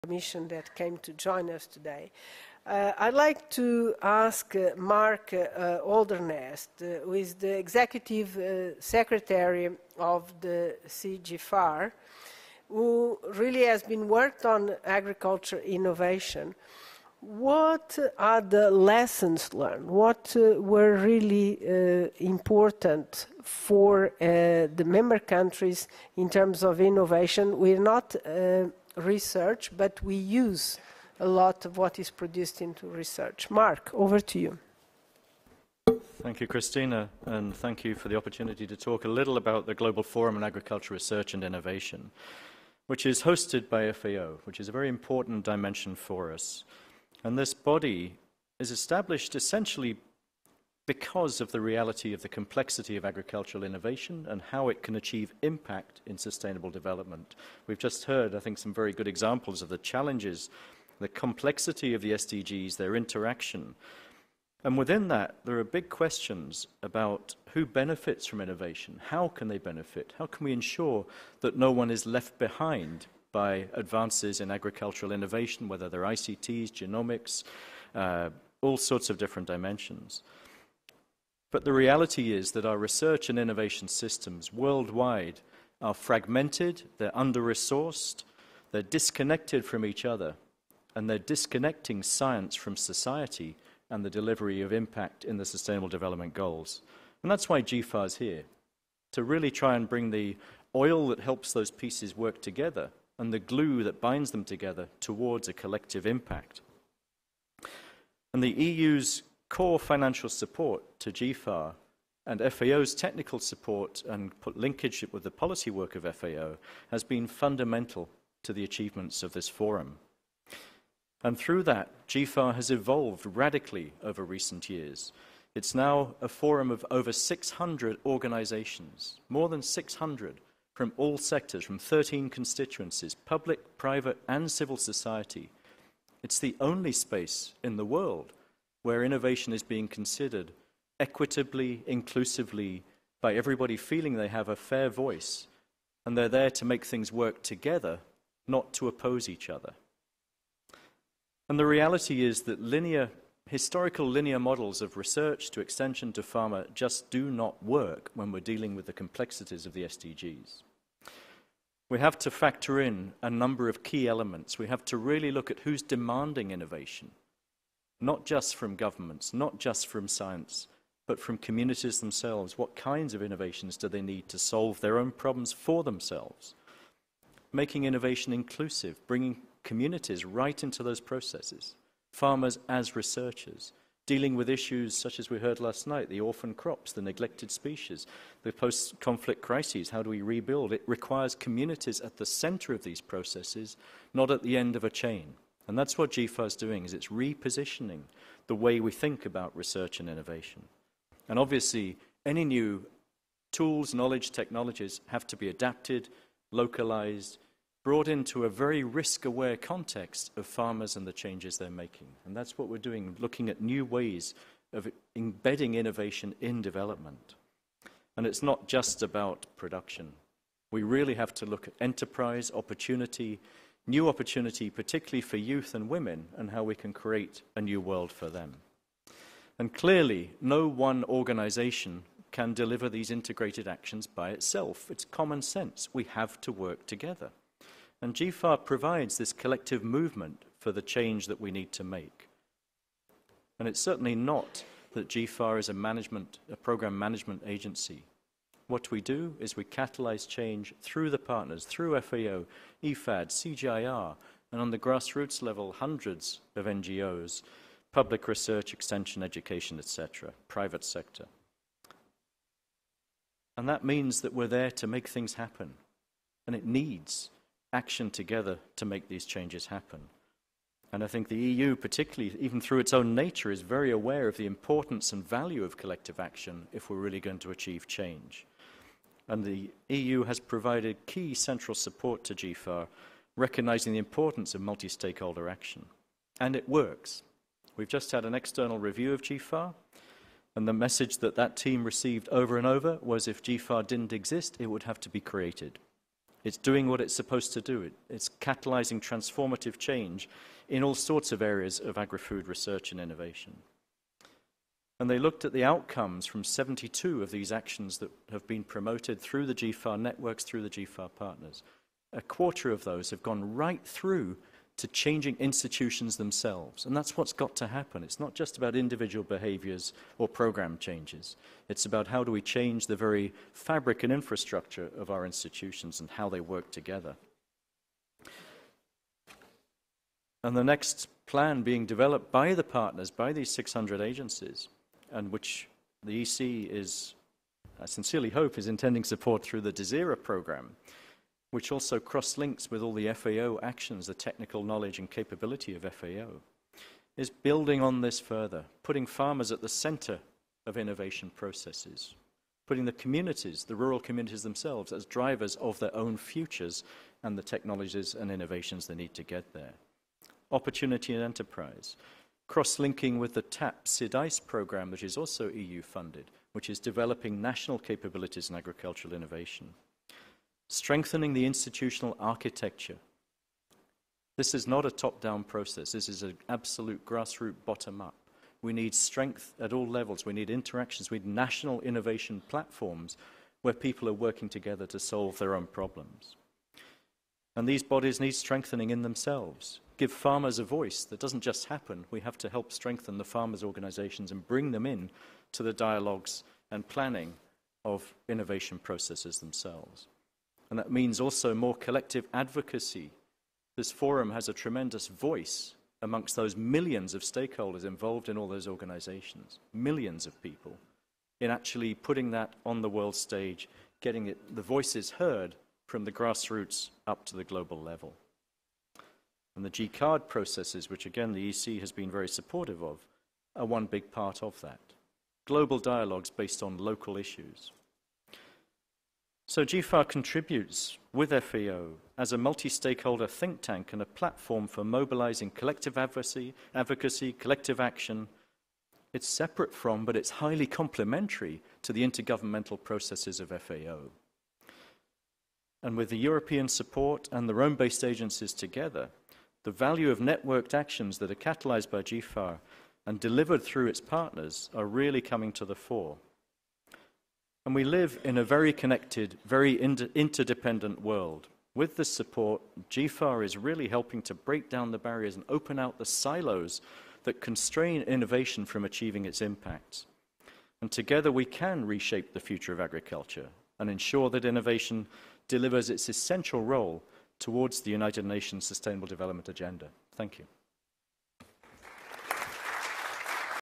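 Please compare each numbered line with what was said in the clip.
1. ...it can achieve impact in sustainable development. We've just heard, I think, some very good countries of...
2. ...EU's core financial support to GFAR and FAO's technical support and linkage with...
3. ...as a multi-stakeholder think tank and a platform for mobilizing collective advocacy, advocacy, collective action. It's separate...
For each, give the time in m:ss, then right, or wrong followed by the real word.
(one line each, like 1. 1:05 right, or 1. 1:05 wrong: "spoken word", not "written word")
1. 0:54 wrong: "examples", not "countries"
2. 1:48 right
3. 7:12 right.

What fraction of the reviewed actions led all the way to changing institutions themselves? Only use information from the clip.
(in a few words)
A quarter.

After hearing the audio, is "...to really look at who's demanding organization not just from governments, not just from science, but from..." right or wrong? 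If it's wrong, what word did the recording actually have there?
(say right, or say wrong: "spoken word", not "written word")
wrong: "innovation", not "organization".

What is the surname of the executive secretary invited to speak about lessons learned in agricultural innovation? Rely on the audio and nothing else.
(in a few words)
Holderness.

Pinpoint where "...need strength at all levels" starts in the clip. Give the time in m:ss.
6:18.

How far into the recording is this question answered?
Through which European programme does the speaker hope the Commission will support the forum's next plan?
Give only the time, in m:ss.
5:39.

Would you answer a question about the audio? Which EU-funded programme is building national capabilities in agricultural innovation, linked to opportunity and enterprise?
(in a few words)
TAP CDAIS.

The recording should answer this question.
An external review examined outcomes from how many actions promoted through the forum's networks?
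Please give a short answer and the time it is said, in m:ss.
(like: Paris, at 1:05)
72, at 5:06.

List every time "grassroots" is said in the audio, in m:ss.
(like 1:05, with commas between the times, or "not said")
4:14, 6:17, 6:56.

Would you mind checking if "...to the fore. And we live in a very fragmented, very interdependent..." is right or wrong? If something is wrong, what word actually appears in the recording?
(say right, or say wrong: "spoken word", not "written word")
wrong: "connected", not "fragmented".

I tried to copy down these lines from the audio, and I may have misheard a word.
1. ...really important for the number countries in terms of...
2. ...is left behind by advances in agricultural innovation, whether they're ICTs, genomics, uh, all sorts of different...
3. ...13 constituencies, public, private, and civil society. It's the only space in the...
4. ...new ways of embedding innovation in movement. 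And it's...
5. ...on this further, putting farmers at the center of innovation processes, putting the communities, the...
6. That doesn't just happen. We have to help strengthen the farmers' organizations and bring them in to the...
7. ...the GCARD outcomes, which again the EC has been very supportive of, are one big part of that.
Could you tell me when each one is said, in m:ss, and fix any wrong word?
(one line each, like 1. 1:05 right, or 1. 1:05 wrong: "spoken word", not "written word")
1. 0:20 wrong: "member", not "number"
2. 1:11 right
3. 2:11 right
4. 3:33 wrong: "development", not "movement"
5. 5:47 right
6. 6:31 right
7. 6:59 wrong: "processes", not "outcomes".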